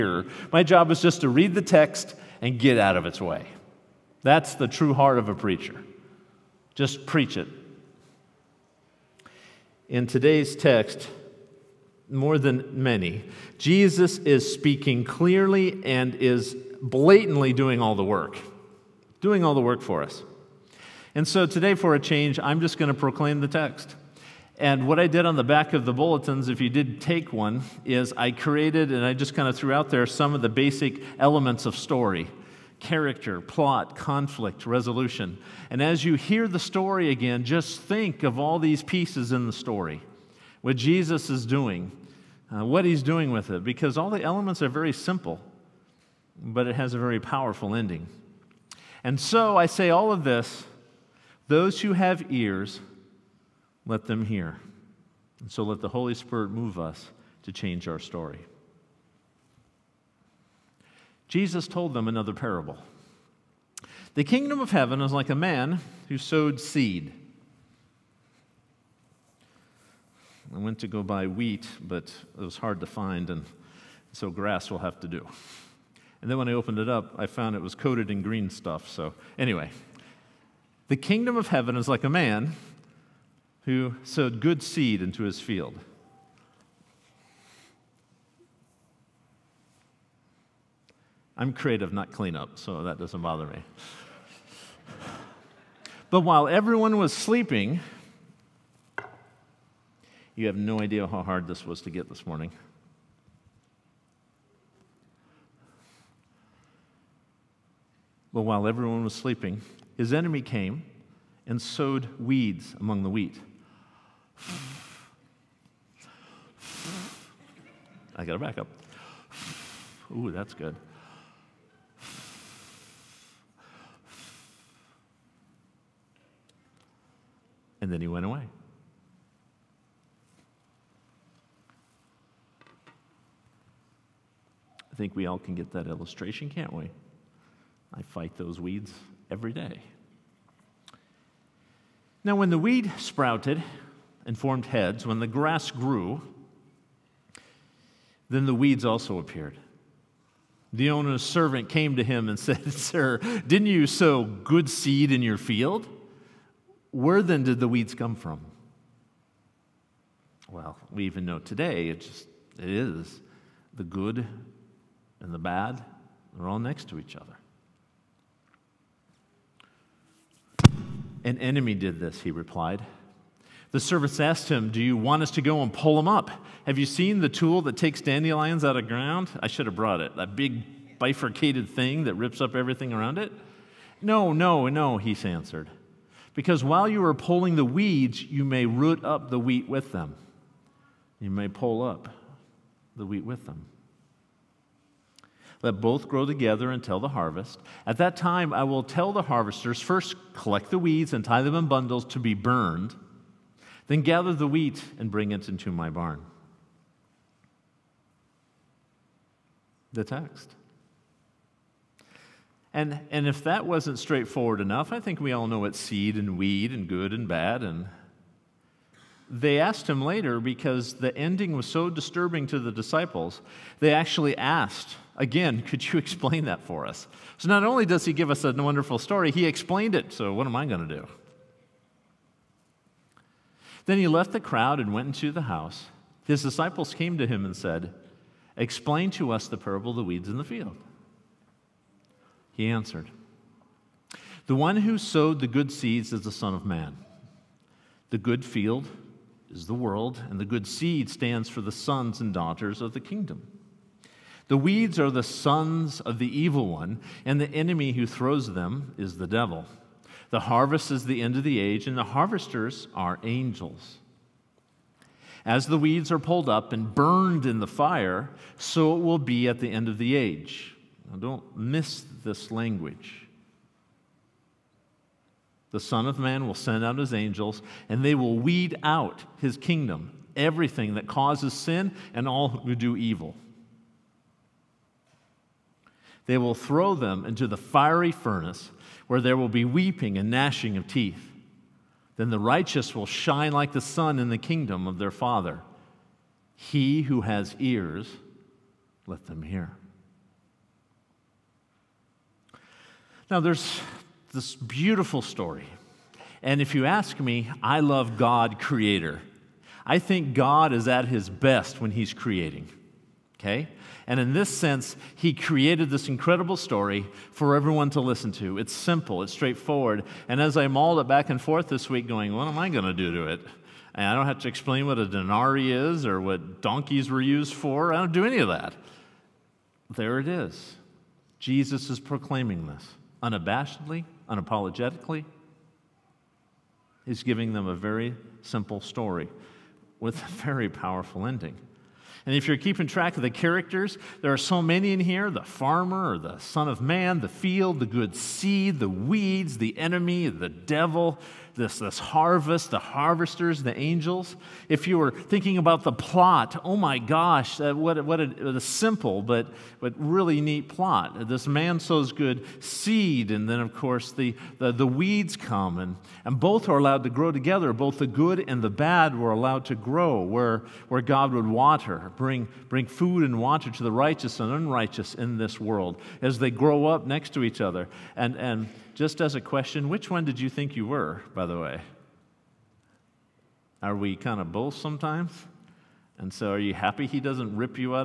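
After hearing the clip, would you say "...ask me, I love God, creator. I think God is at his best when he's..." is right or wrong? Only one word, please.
right.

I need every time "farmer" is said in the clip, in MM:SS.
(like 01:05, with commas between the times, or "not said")
05:45.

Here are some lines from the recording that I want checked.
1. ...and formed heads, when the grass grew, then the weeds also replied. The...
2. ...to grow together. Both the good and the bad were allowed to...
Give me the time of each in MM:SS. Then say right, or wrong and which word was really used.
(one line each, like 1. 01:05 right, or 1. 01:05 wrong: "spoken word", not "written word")
1. 02:24 wrong: "appeared", not "replied"
2. 06:07 right.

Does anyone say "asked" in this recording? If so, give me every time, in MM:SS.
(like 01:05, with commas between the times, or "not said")
02:54, 03:39, 03:44.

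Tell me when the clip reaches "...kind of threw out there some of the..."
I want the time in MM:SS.
00:29.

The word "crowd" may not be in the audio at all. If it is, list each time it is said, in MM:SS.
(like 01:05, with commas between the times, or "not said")
03:54.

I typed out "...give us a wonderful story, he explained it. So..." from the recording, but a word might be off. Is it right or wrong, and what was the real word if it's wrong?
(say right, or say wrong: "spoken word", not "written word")
right.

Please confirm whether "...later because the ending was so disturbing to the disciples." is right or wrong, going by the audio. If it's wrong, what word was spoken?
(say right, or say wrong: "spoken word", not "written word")
right.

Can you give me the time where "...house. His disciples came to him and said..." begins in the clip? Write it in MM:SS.
03:55.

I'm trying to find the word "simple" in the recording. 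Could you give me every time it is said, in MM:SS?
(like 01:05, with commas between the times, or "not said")
00:44, 05:18, 05:38, 05:58.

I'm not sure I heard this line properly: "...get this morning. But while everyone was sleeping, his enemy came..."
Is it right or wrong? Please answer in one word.
right.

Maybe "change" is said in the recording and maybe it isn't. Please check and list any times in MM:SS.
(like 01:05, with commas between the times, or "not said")
00:21, 00:57.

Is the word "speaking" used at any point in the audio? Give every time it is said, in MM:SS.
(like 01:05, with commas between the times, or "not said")
00:14.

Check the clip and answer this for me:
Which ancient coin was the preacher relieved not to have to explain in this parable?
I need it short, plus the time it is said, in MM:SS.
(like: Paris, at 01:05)
denarii, at 05:25.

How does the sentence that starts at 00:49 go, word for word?
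And so I say all of this those who have ears, let them hear.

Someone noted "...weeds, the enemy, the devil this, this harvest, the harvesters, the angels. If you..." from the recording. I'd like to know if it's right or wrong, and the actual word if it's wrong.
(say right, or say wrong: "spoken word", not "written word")
right.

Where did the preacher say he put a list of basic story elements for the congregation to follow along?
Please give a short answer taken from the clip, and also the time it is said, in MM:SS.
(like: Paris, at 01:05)
back of the bulletins, at 00:25.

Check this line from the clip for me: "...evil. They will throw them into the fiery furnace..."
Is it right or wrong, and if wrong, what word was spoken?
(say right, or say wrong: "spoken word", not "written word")
right.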